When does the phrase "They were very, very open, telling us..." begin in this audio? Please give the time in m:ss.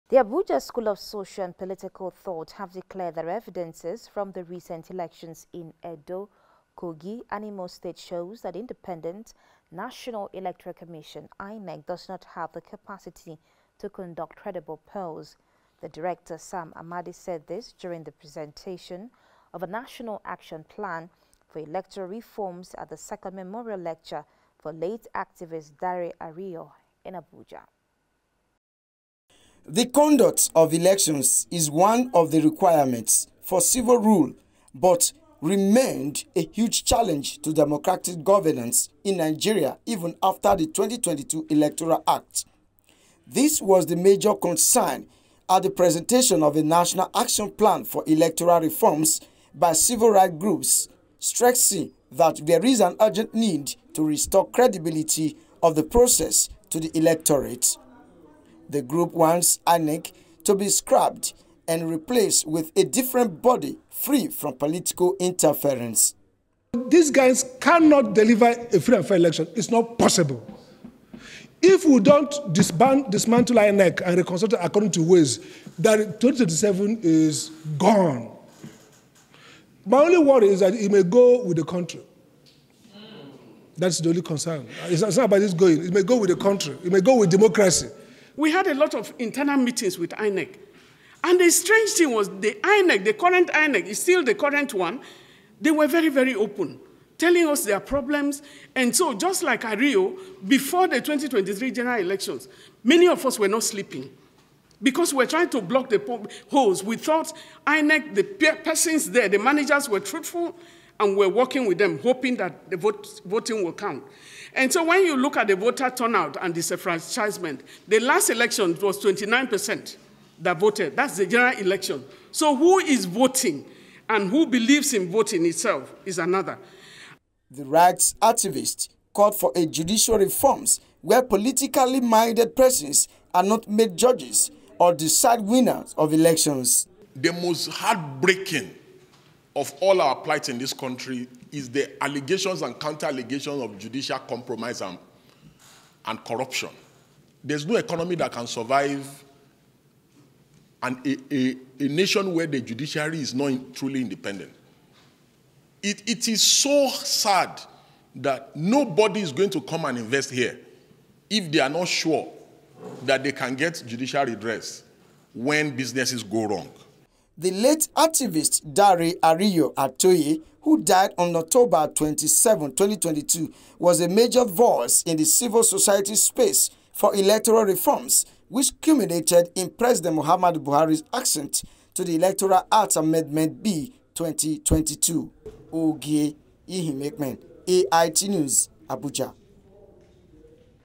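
1:35.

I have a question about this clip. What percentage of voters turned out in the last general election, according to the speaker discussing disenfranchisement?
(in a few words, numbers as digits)
29%.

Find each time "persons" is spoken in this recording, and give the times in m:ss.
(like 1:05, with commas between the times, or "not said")
1:48, 2:12.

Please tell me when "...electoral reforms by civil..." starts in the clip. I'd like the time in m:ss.
0:48.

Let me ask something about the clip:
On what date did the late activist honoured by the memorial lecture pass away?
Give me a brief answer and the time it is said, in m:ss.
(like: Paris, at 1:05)
October 27, 2022, at 2:51.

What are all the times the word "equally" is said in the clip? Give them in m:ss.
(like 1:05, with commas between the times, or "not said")
not said.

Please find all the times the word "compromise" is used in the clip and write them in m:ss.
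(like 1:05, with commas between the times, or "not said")
2:24.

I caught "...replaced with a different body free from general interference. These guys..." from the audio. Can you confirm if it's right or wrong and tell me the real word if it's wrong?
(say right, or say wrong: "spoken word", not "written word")
wrong: "political", not "general".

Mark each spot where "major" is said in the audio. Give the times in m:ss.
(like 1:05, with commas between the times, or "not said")
0:43, 2:54.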